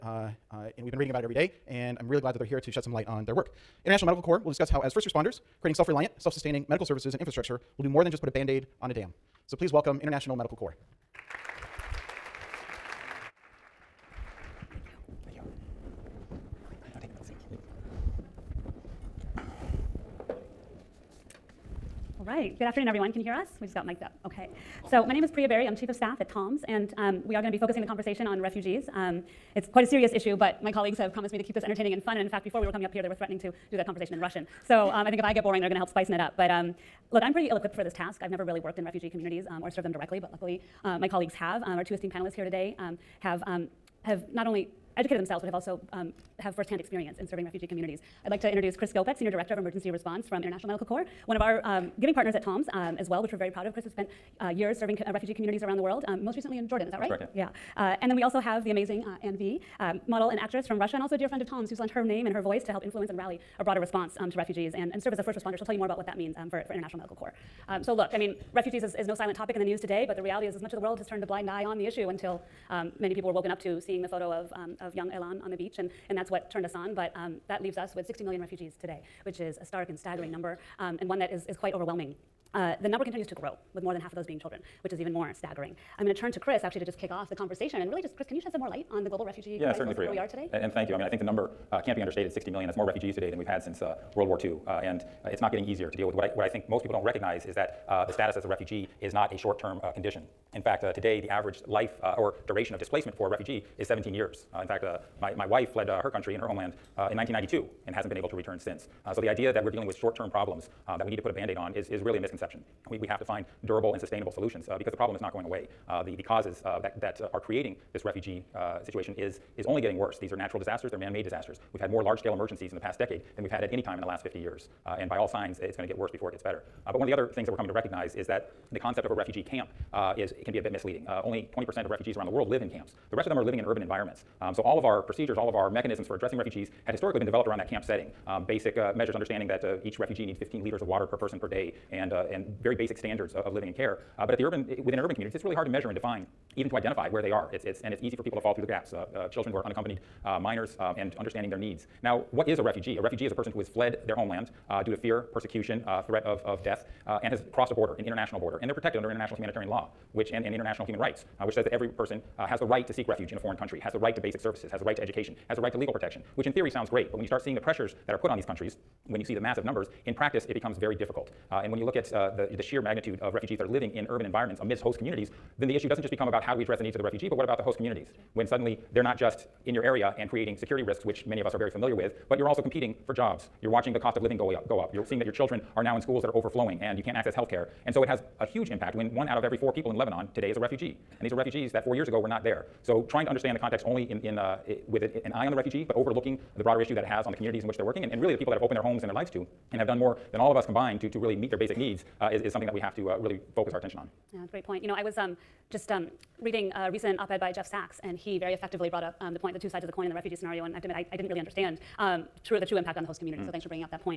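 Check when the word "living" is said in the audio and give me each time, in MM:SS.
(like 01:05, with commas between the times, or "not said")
02:13, 02:23, 02:53, 03:04.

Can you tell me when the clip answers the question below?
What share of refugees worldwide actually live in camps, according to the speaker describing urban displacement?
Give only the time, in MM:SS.
02:11.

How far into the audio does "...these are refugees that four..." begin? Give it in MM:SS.
03:11.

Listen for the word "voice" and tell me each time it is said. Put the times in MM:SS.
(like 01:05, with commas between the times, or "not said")
01:02.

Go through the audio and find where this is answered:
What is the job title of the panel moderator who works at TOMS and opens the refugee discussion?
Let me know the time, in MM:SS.
00:25.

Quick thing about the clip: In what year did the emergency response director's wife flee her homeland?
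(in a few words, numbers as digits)
1992.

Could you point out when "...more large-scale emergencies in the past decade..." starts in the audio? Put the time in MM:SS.
02:01.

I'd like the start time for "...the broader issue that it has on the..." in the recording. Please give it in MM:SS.
03:16.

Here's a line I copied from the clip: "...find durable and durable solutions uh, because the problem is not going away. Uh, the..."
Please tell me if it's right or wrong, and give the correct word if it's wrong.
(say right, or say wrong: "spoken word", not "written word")
wrong: "sustainable", not "durable".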